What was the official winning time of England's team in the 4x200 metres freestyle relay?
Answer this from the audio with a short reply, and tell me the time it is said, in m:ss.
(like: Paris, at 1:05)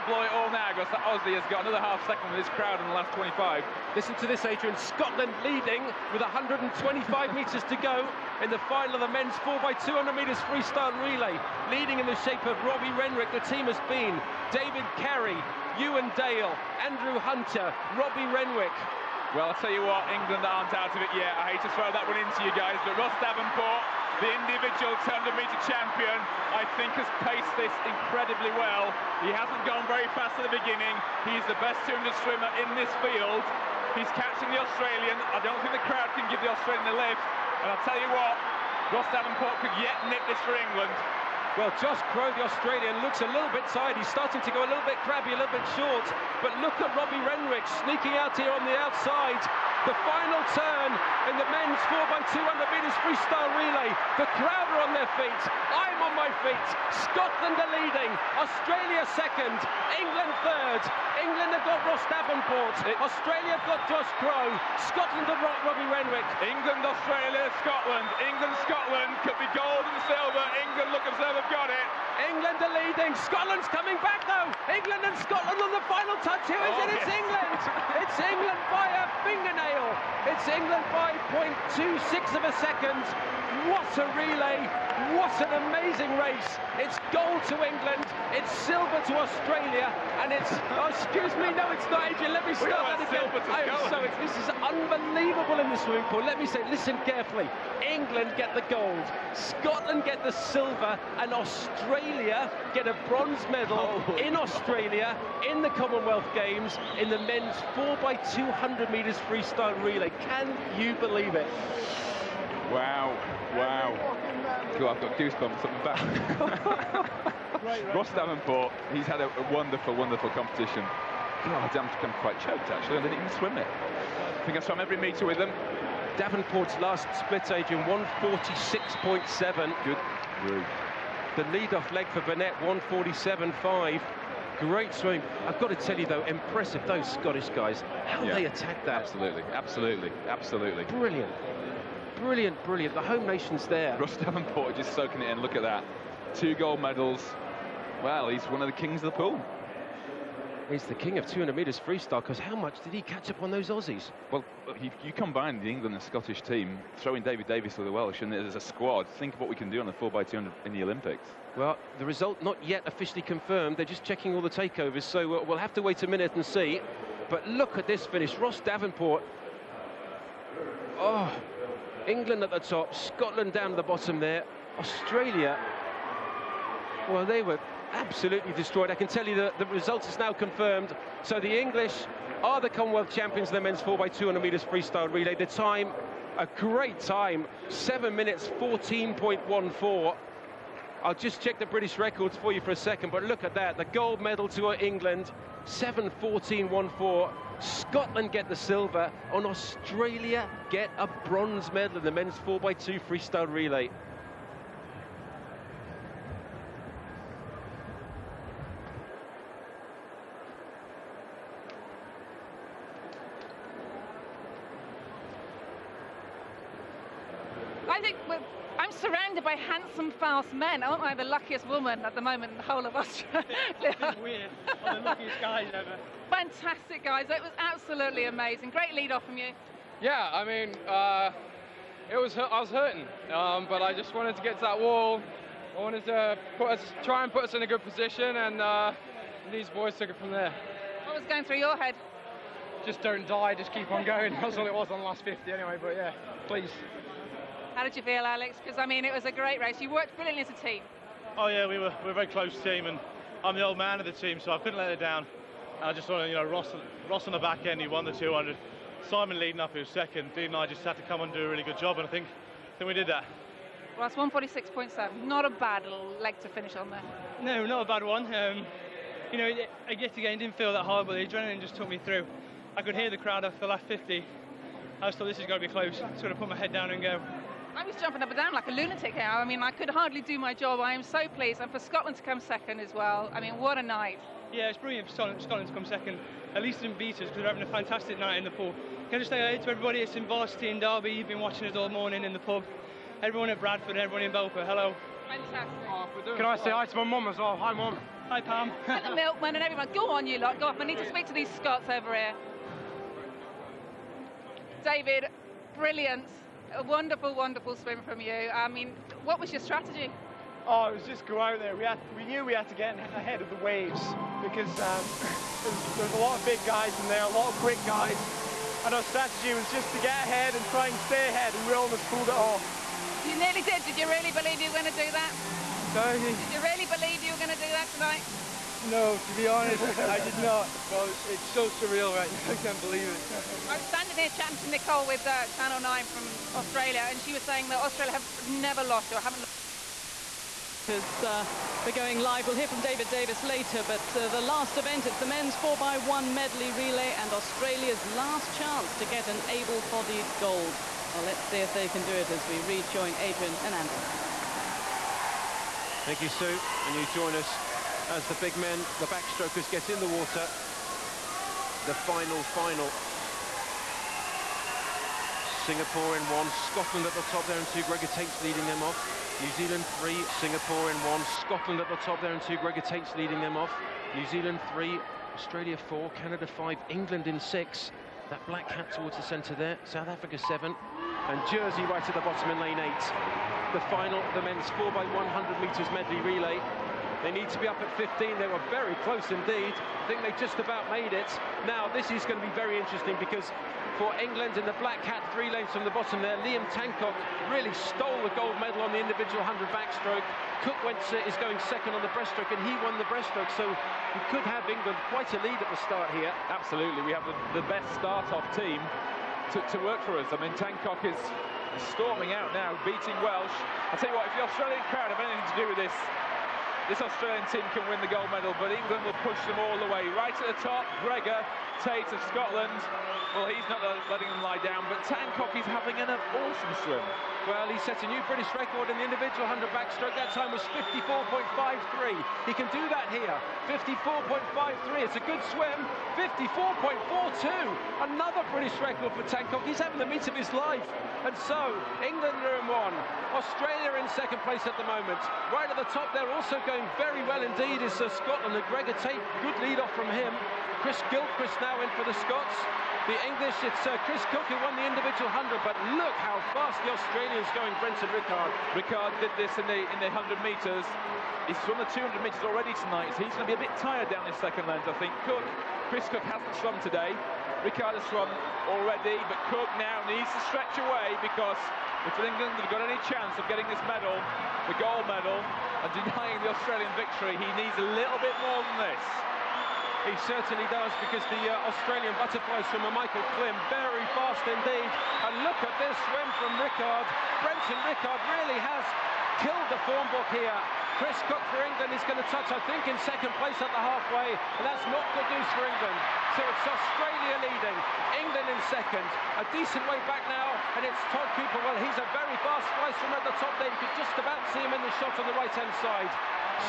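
7:14.14, at 3:07.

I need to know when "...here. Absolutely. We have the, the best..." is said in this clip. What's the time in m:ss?
6:46.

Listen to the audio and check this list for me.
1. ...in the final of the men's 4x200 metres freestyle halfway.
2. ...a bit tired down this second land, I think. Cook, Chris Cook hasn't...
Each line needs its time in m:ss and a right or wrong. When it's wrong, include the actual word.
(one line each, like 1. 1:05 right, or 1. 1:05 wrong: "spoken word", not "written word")
1. 0:08 wrong: "relay", not "halfway"
2. 7:43 right.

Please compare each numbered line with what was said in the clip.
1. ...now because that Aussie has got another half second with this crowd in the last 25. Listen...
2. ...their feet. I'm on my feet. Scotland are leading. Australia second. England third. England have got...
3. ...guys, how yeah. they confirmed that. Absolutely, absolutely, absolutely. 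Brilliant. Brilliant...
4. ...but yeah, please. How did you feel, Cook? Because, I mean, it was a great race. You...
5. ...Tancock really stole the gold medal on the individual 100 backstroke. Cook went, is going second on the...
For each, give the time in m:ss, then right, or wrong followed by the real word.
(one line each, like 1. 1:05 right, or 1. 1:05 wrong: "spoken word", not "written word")
1. 0:00 right
2. 0:54 right
3. 2:17 wrong: "attacked", not "confirmed"
4. 4:05 wrong: "Alex", not "Cook"
5. 6:36 right.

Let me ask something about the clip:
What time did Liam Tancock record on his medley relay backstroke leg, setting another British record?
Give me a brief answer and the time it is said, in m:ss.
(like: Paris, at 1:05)
54.42, at 7:16.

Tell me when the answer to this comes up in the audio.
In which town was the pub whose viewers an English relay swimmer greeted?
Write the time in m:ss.
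4:50.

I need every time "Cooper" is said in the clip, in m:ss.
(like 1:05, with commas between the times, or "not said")
8:21.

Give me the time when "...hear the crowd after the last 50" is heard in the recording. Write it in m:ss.
4:32.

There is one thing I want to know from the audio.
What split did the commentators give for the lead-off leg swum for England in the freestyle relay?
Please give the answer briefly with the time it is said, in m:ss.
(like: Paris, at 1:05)
147.5, at 2:12.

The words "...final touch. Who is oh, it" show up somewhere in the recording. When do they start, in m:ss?
1:15.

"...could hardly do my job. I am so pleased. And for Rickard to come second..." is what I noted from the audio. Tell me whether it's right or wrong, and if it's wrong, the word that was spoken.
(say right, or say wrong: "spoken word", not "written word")
wrong: "Scotland", not "Rickard".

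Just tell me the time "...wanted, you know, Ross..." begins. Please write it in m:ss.
4:16.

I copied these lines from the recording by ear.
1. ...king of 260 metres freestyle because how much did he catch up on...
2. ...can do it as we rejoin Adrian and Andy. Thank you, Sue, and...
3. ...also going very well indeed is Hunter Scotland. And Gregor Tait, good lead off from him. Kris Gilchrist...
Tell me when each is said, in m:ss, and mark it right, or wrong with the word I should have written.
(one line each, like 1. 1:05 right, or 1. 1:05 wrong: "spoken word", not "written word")
1. 2:30 wrong: "200", not "260"
2. 5:51 right
3. 7:26 wrong: "Sir", not "Hunter".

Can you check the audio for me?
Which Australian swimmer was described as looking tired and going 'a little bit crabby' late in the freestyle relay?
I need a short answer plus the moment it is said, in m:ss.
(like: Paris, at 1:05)
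Josh Crowe, at 0:41.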